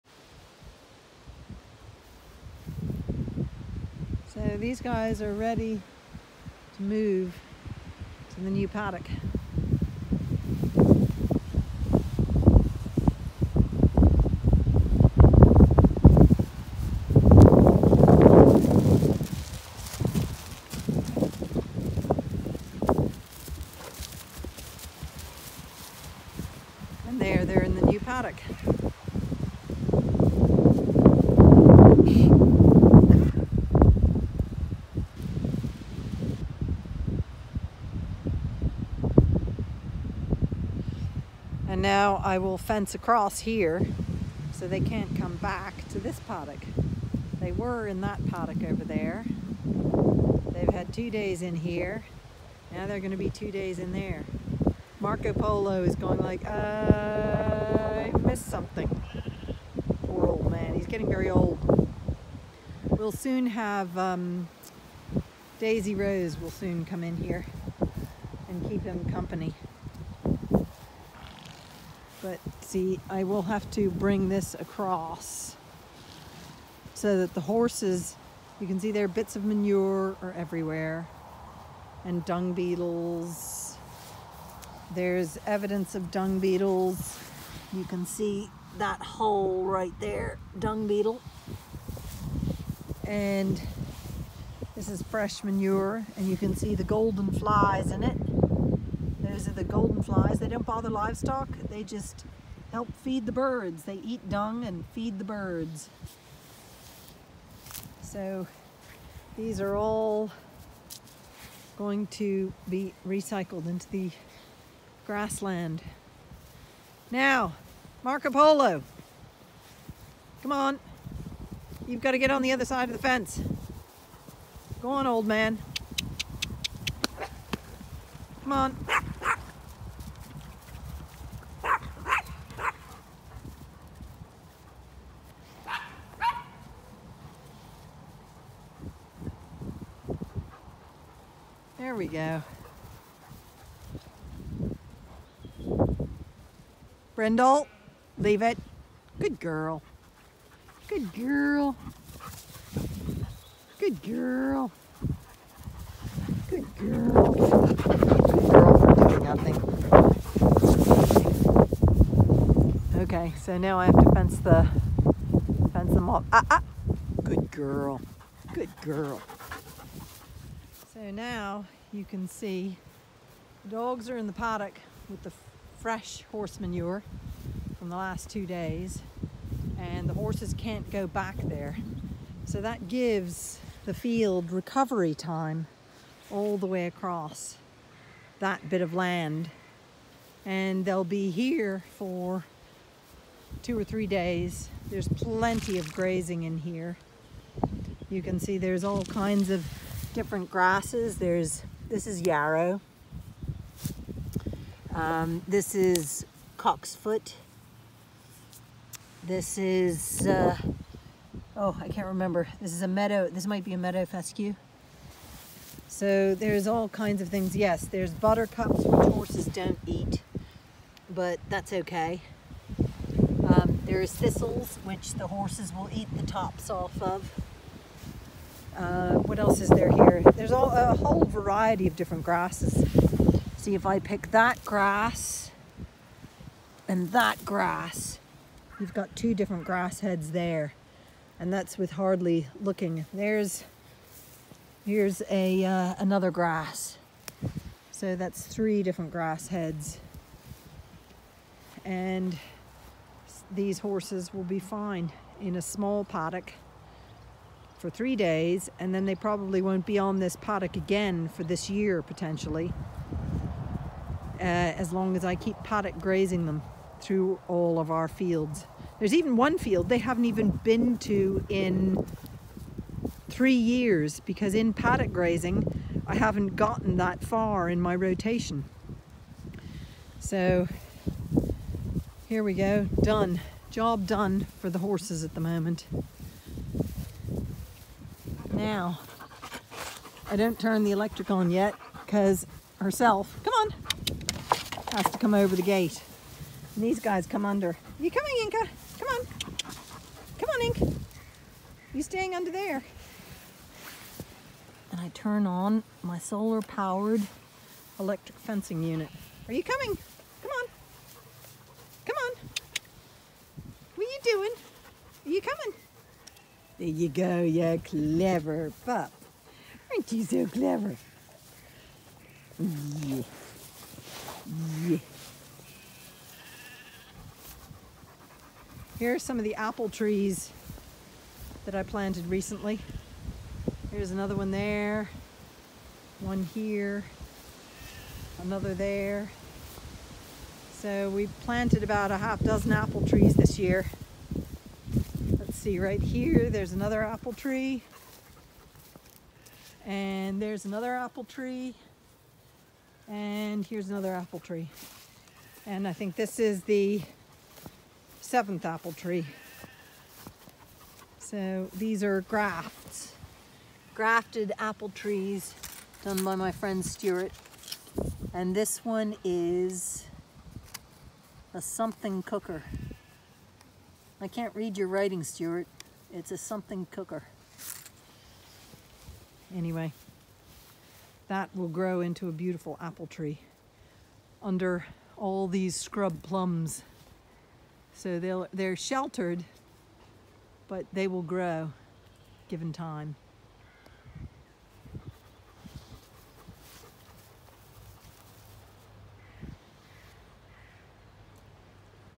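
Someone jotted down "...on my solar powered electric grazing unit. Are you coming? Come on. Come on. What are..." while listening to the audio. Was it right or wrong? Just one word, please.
wrong.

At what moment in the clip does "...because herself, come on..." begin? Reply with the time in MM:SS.
04:52.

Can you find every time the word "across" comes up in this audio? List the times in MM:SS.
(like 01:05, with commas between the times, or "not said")
00:42, 01:14, 03:06.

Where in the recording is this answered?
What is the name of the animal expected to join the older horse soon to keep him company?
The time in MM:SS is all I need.
01:05.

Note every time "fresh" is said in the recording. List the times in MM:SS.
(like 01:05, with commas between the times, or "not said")
01:35, 02:55.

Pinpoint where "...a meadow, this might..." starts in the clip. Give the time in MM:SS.
03:32.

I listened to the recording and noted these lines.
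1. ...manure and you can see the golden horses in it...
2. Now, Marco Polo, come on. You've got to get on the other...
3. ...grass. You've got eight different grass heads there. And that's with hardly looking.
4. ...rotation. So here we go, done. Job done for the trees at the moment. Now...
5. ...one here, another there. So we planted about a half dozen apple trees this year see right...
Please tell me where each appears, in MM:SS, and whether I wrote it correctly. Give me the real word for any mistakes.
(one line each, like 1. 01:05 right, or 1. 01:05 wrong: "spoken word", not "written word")
1. 01:35 wrong: "flies", not "horses"
2. 01:57 right
3. 03:57 wrong: "two", not "eight"
4. 04:37 wrong: "horses", not "trees"
5. 05:36 right.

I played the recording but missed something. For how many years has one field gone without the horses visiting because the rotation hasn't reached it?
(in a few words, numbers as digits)
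3.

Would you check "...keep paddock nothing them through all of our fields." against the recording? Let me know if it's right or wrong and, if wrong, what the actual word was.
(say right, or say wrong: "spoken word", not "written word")
wrong: "grazing", not "nothing".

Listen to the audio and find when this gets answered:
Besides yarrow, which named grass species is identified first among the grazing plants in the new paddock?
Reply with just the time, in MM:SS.
03:26.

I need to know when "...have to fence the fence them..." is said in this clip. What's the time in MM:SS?
02:43.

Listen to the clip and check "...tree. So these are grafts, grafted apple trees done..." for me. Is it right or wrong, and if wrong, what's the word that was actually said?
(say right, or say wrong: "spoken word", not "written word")
right.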